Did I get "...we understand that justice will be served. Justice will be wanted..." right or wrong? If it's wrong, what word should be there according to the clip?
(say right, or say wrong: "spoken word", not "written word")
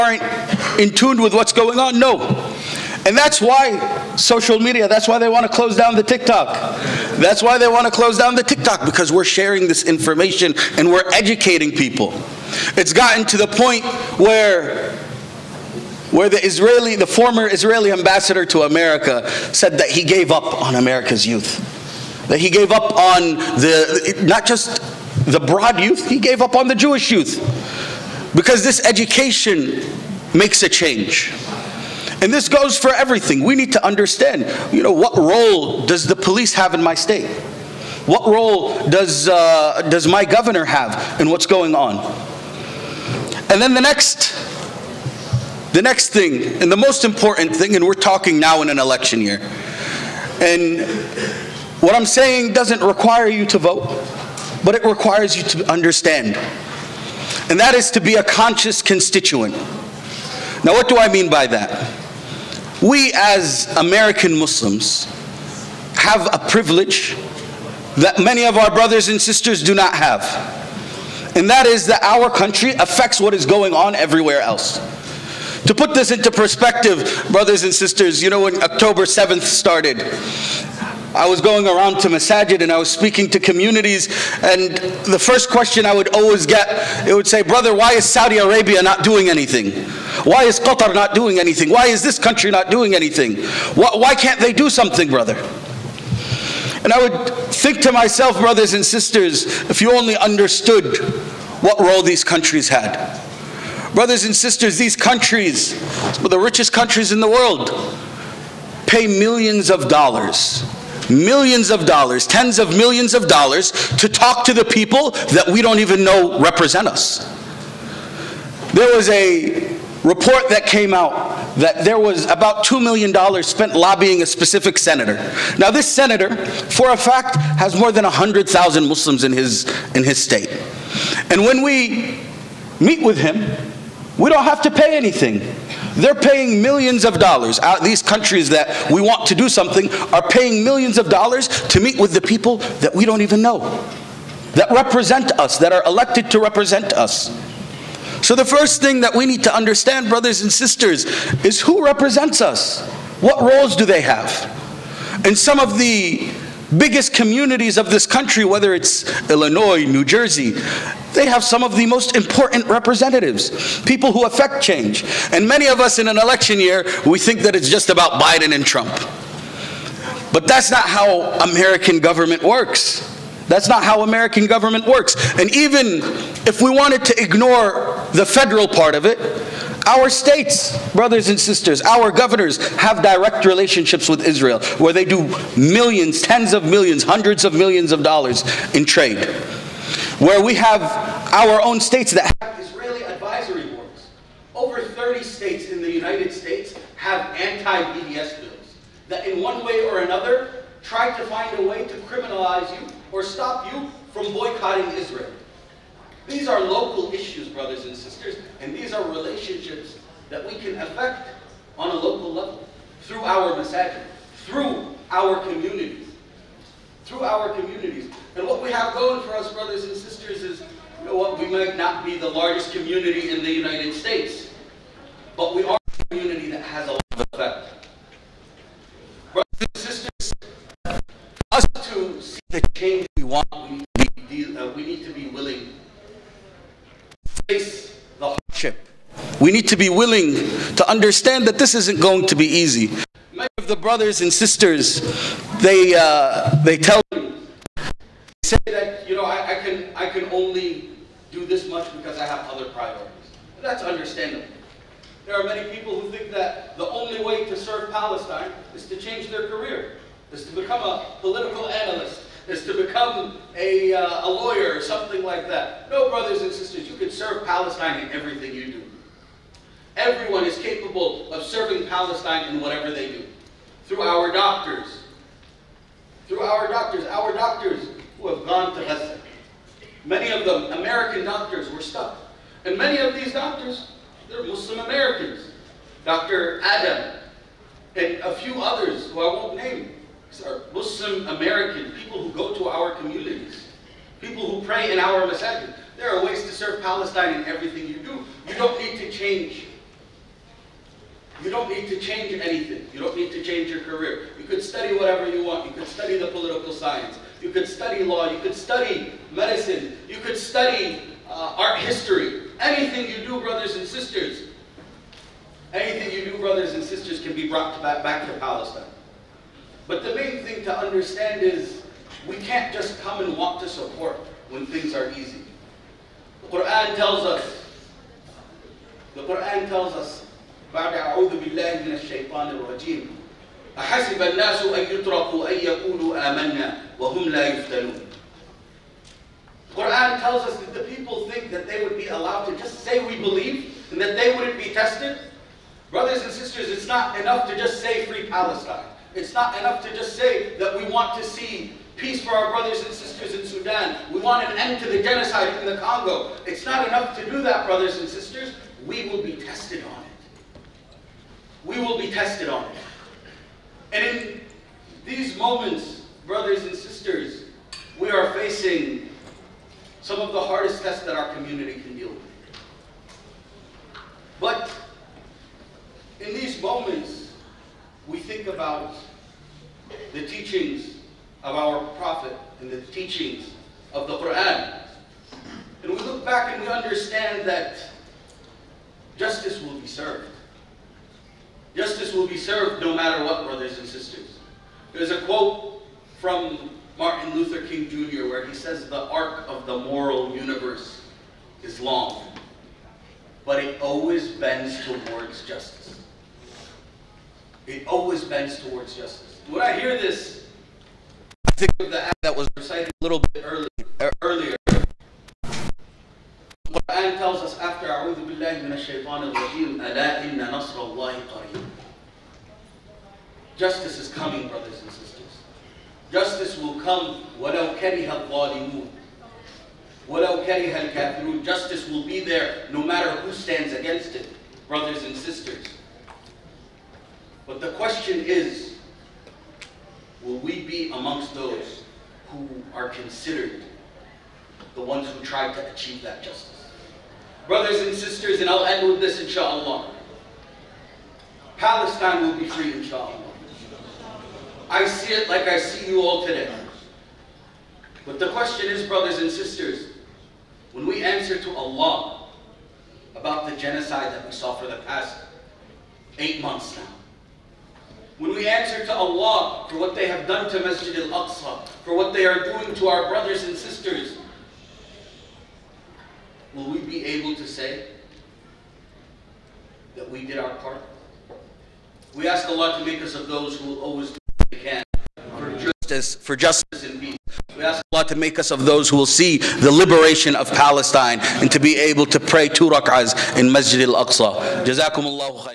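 wrong: "served", not "wanted".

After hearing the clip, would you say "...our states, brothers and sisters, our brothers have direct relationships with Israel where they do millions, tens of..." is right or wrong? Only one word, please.
wrong.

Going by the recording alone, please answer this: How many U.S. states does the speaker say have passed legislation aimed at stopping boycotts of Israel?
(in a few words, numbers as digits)
over 30.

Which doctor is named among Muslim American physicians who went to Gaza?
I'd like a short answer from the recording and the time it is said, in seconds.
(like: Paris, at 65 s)
Dr. Adam, at 286 s.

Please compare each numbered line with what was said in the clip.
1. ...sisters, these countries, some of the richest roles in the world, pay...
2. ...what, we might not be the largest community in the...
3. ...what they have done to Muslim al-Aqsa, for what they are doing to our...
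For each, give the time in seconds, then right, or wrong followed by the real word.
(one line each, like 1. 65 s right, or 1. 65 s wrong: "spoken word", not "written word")
1. 104 s wrong: "countries", not "roles"
2. 221 s right
3. 469 s wrong: "Masjid", not "Muslim".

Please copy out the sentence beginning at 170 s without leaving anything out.
But that's not how American government works.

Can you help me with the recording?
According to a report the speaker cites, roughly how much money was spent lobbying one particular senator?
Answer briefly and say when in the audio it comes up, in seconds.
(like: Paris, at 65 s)
$2 million, at 122 s.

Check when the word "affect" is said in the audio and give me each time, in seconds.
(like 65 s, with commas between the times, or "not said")
72 s, 164 s, 210 s.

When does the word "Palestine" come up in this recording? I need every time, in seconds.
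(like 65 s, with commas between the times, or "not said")
257 s, 267 s, 271 s, 296 s, 318 s, 348 s, 451 s, 490 s.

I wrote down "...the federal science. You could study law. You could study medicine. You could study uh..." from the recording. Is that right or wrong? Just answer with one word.
wrong.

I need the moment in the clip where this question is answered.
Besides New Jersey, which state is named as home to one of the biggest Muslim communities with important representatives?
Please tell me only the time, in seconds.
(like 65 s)
159 s.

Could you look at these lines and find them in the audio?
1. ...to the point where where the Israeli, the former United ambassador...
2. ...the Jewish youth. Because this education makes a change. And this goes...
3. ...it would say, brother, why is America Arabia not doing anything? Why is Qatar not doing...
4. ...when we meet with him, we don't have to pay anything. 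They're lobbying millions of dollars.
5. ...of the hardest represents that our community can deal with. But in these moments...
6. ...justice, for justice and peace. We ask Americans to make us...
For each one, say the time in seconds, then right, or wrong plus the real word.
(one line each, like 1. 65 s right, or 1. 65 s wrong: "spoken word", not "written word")
1. 13 s wrong: "Israeli", not "United"
2. 26 s right
3. 87 s wrong: "Saudi", not "America"
4. 131 s wrong: "paying", not "lobbying"
5. 370 s wrong: "tests", not "represents"
6. 485 s wrong: "Allah", not "Americans".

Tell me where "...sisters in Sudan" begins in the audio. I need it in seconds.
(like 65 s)
352 s.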